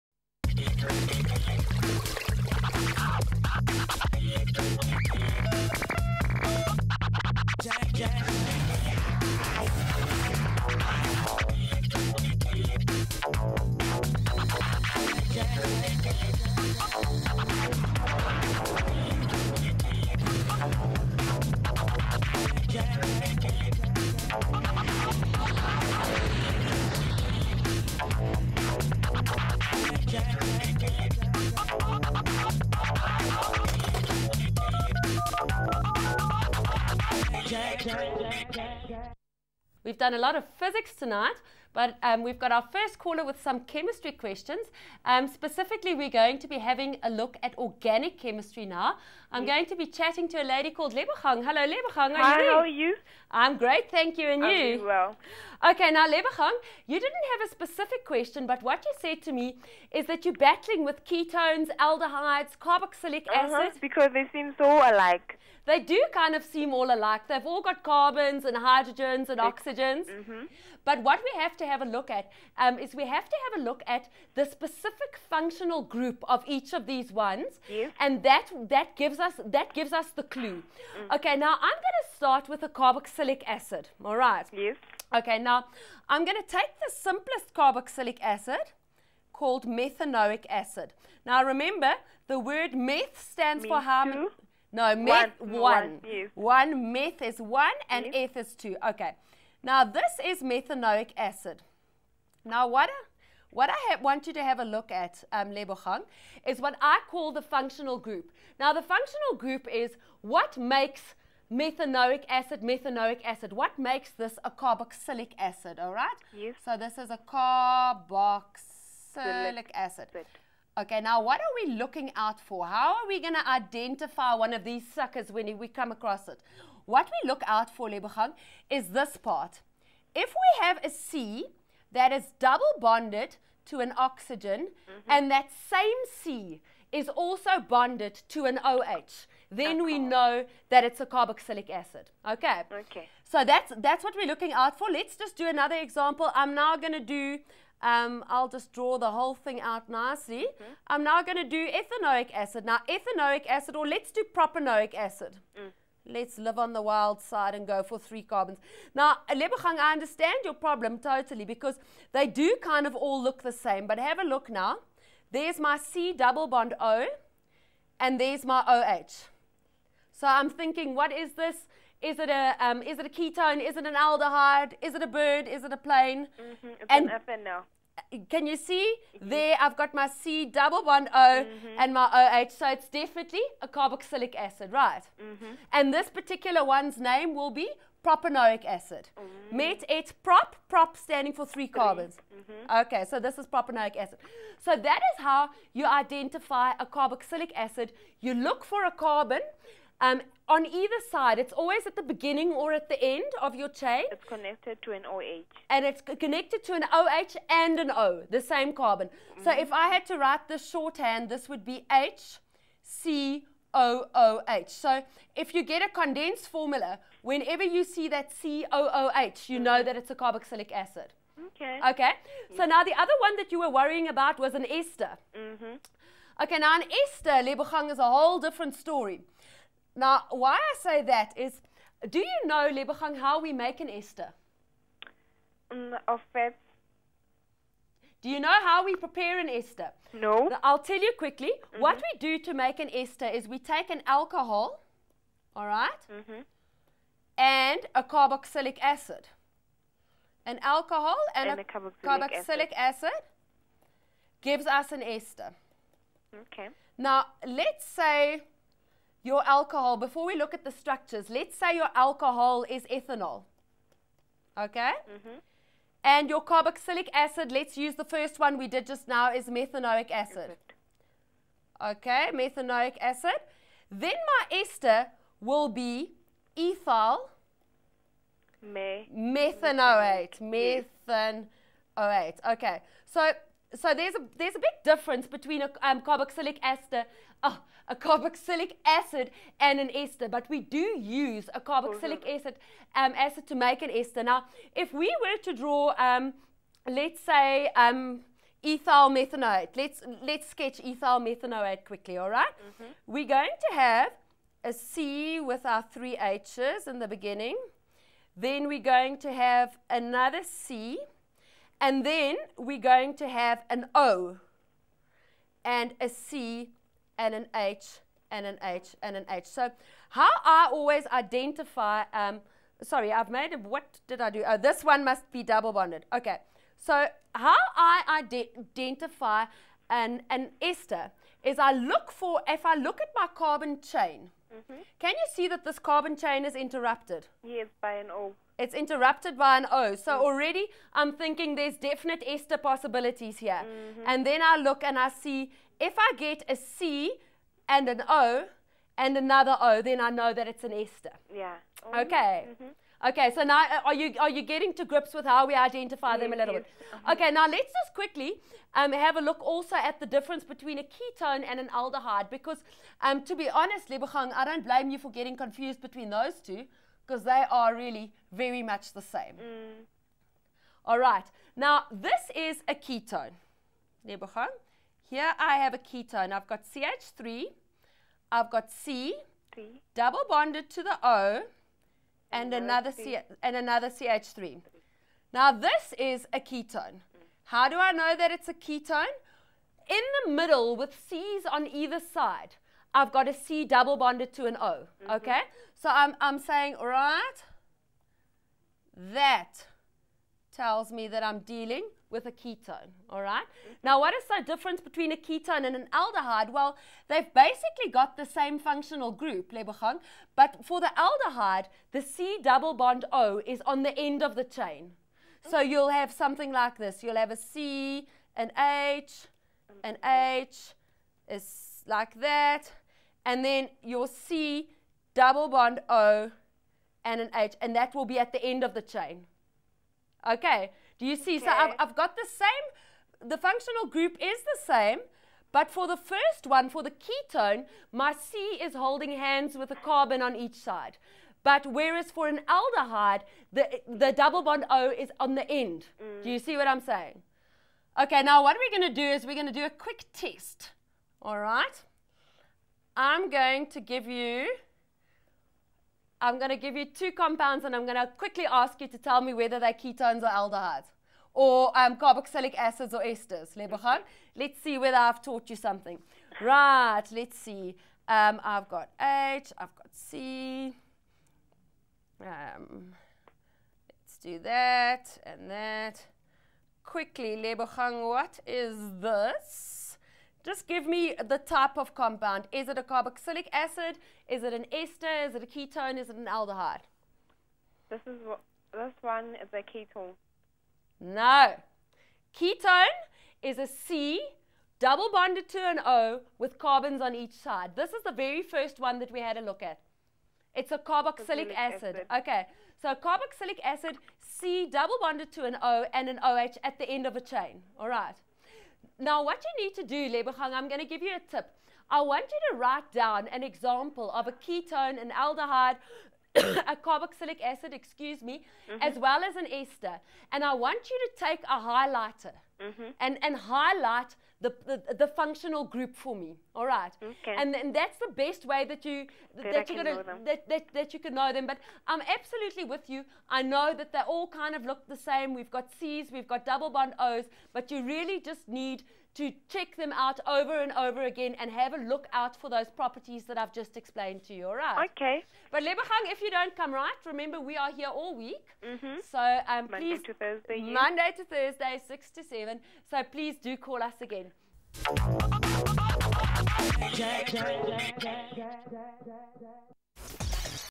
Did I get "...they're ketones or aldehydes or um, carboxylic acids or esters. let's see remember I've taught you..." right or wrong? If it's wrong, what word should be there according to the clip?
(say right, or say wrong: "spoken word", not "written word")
wrong: "whether", not "remember".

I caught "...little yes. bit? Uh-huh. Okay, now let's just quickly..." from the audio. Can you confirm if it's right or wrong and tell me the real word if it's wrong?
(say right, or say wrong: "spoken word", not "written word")
right.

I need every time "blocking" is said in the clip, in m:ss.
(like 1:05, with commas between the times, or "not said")
not said.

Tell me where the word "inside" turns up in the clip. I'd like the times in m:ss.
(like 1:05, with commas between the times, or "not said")
not said.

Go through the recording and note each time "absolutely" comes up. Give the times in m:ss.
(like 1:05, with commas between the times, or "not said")
8:52.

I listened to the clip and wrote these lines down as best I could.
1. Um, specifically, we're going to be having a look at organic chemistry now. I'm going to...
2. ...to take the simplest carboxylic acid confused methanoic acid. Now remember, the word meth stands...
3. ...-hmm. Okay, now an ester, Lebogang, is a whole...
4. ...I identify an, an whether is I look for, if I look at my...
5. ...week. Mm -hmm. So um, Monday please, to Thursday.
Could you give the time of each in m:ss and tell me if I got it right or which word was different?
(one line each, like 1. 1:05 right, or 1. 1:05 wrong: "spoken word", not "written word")
1. 0:45 right
2. 1:26 wrong: "called", not "confused"
3. 3:45 right
4. 5:27 wrong: "ester", not "whether"
5. 9:08 right.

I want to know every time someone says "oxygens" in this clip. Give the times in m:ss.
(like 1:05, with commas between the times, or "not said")
1:09, 2:13.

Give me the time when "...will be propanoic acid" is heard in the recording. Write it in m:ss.
3:07.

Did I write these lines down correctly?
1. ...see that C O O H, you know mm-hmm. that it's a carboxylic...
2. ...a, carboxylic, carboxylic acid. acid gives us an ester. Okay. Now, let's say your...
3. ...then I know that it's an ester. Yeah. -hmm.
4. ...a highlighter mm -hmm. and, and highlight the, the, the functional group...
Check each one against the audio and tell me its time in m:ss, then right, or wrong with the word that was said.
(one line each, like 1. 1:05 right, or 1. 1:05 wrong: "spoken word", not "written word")
1. 3:37 right
2. 4:11 right
3. 5:49 right
4. 8:41 right.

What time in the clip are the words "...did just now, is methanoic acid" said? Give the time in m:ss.
4:28.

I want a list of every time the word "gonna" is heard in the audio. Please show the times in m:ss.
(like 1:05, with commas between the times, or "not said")
8:49.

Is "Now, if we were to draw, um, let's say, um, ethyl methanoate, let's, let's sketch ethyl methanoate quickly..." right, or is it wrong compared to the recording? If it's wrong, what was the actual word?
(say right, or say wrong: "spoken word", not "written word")
right.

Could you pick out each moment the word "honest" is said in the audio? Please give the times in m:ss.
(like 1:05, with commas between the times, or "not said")
6:03.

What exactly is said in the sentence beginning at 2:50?
So I'm thinking, what is this?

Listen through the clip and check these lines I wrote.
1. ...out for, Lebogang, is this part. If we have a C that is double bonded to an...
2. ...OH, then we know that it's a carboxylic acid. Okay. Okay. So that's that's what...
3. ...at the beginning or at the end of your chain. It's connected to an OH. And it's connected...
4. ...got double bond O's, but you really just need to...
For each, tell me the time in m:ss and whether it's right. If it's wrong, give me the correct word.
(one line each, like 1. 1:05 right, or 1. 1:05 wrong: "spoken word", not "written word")
1. 2:07 right
2. 2:18 right
3. 3:21 right
4. 8:56 right.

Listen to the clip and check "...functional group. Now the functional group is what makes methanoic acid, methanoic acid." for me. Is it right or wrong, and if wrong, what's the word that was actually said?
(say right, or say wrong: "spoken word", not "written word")
right.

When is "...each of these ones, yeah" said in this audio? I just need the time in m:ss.
1:16.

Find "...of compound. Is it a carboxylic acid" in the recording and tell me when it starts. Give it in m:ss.
8:01.